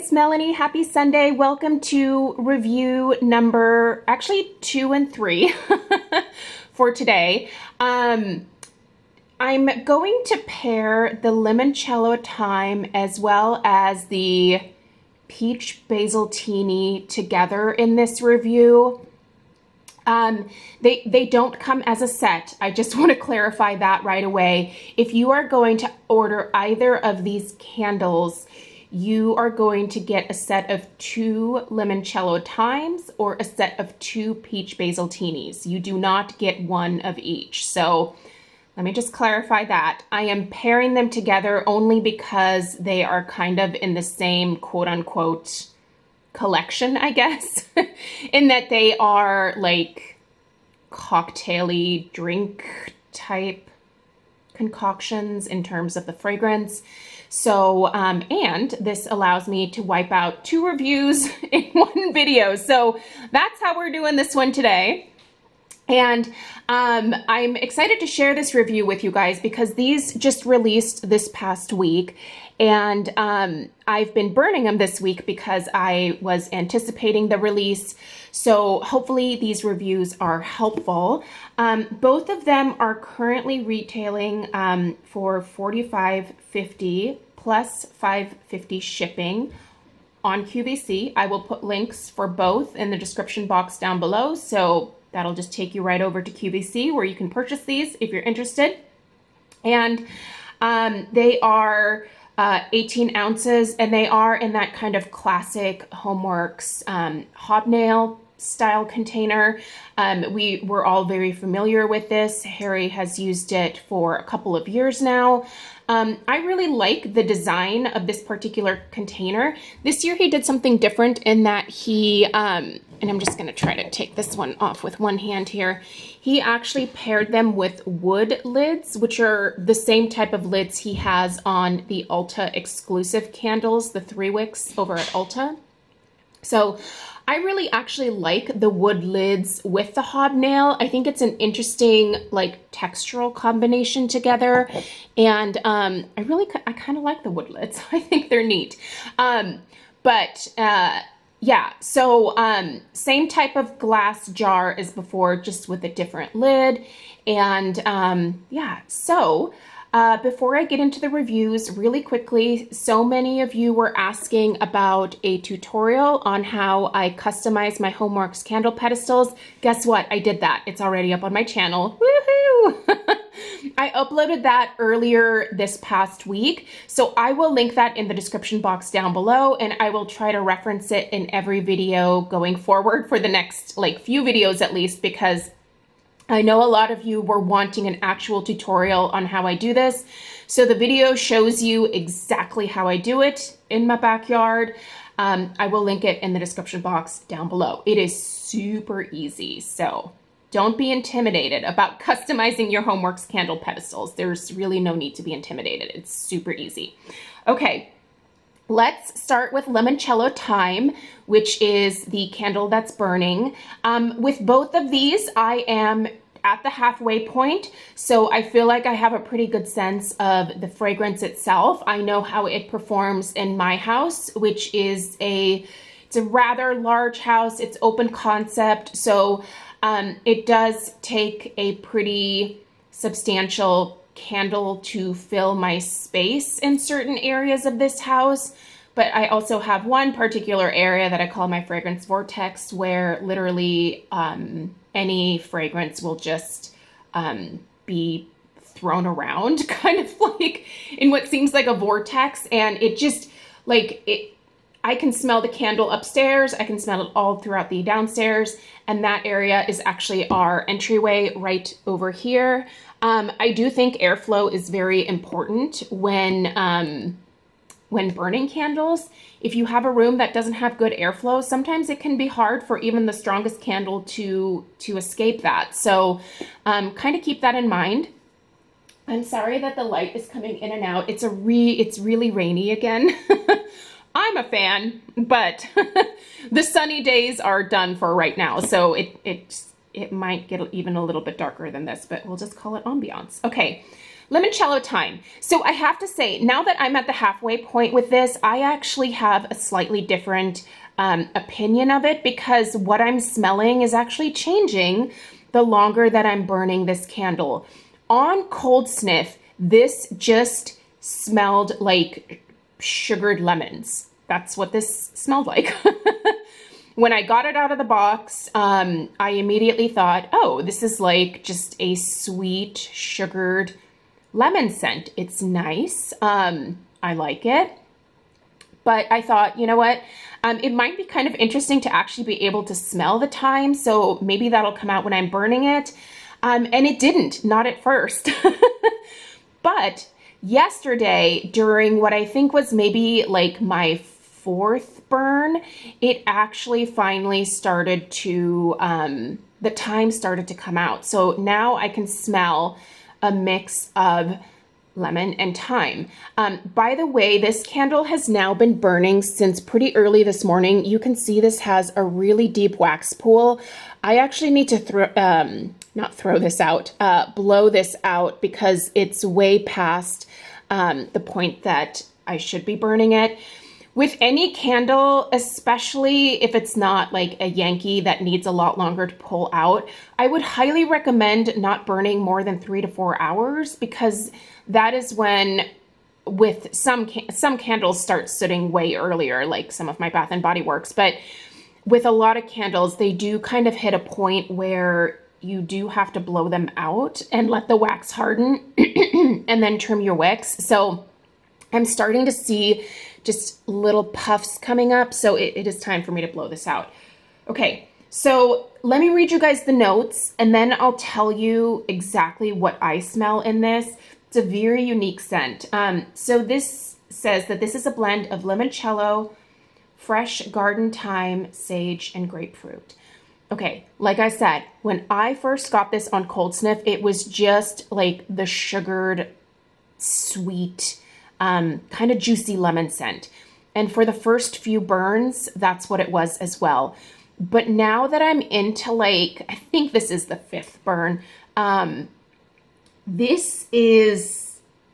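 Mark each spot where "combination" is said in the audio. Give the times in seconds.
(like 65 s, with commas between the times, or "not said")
143 s.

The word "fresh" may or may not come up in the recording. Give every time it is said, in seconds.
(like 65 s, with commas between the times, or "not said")
419 s.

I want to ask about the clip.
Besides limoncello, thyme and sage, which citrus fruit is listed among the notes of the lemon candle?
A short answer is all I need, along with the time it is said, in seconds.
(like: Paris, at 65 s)
Grapefruit, at 422 s.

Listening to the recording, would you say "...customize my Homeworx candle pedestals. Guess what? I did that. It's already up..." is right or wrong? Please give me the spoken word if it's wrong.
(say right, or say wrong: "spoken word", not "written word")
right.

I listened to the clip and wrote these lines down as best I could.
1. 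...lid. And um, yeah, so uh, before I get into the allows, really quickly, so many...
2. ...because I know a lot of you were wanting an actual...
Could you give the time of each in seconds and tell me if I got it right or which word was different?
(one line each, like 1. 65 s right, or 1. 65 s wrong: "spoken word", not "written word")
1. 156 s wrong: "reviews", not "allows"
2. 185 s right.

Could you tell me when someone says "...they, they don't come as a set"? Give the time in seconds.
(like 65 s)
20 s.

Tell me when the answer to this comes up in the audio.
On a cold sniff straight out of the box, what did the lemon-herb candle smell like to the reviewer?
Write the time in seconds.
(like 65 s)
312 s.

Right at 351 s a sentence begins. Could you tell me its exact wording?
So now I can smell a mix of lemon, and thyme.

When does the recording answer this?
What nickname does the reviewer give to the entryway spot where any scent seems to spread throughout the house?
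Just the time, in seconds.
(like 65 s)
241 s.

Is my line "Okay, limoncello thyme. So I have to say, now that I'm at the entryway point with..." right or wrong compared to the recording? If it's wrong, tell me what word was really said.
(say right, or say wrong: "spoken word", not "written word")
wrong: "halfway", not "entryway".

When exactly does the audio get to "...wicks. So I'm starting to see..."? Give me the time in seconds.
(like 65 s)
400 s.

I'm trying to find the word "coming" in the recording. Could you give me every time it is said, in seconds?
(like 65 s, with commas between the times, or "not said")
280 s, 404 s.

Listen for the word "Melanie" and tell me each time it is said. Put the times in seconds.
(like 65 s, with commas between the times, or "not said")
0 s.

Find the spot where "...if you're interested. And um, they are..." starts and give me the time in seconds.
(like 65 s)
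98 s.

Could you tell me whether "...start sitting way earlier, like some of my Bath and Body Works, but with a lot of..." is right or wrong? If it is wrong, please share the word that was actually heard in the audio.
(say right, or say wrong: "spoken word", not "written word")
right.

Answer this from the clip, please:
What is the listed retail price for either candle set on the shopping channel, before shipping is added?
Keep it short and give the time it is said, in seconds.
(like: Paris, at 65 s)
$45.50, at 85 s.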